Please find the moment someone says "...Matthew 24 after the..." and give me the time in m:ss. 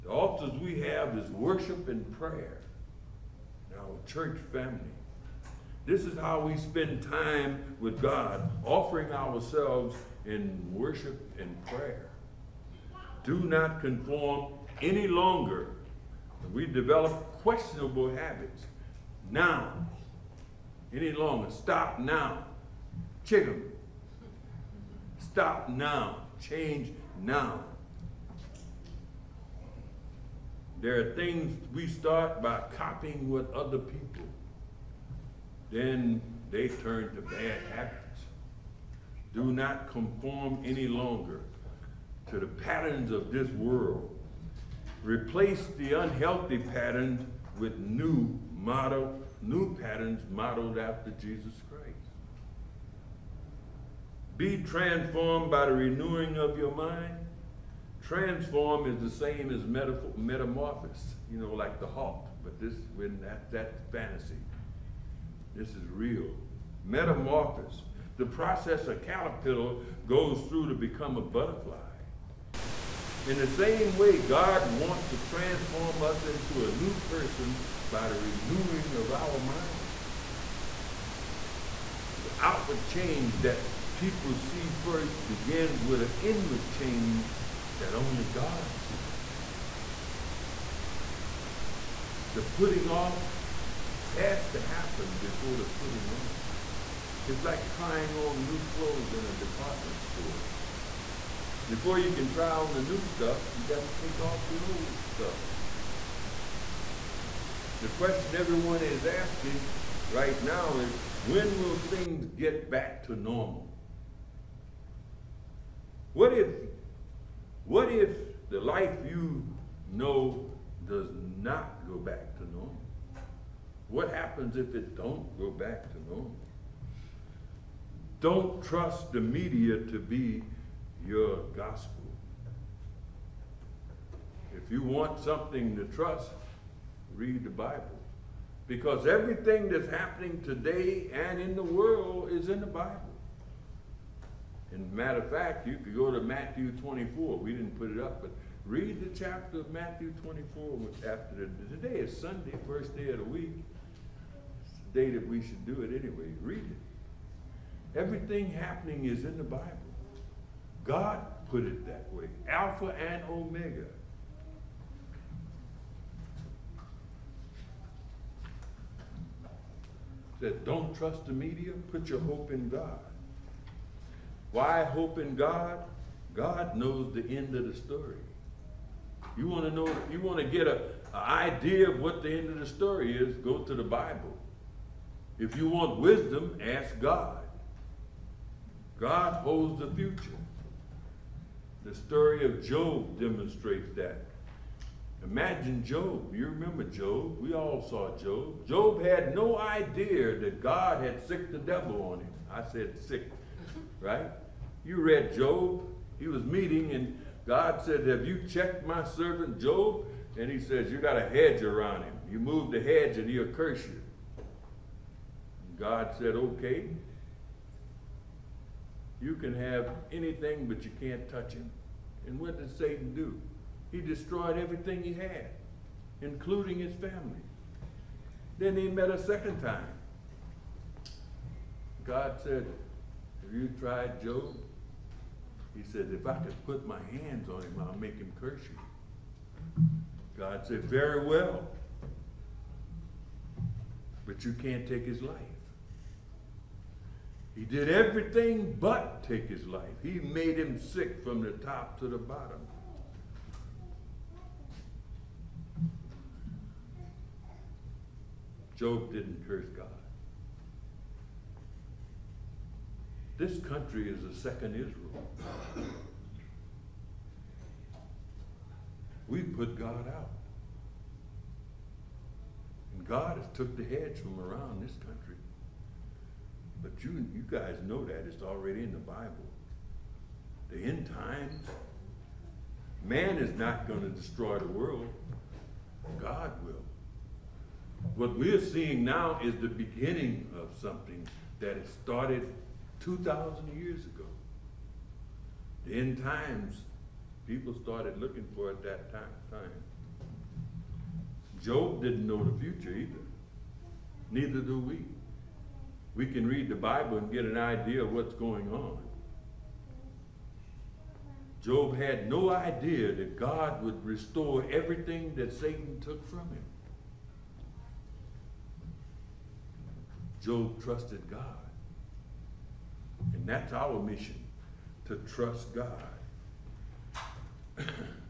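2:29.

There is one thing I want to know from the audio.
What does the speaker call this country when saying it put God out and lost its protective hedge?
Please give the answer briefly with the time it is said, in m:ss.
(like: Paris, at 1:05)
A second Israel, at 4:24.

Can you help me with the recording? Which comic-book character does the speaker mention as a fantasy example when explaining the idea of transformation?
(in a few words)
The Hulk.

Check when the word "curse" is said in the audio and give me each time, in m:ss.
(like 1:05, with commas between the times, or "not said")
3:33, 3:58, 4:19.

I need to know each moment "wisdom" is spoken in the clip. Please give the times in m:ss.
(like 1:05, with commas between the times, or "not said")
3:06.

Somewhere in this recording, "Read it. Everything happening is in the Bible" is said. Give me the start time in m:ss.
2:36.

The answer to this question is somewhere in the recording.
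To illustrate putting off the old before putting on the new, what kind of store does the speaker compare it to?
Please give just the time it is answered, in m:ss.
1:39.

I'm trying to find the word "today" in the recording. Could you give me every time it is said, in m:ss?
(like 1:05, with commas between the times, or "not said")
2:20, 2:31.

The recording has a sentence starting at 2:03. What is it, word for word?
What happens if it don't go back to normal?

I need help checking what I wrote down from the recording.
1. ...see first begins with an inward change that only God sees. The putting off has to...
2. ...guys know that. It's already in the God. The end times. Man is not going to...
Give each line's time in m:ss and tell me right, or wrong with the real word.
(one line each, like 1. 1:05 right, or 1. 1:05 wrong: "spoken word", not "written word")
1. 1:24 right
2. 4:37 wrong: "Bible", not "God".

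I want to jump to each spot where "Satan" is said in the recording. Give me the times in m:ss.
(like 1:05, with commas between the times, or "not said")
3:42, 5:15.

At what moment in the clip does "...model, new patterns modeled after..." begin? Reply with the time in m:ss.
0:48.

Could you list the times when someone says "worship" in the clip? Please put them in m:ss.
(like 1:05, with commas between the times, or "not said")
0:01, 0:10.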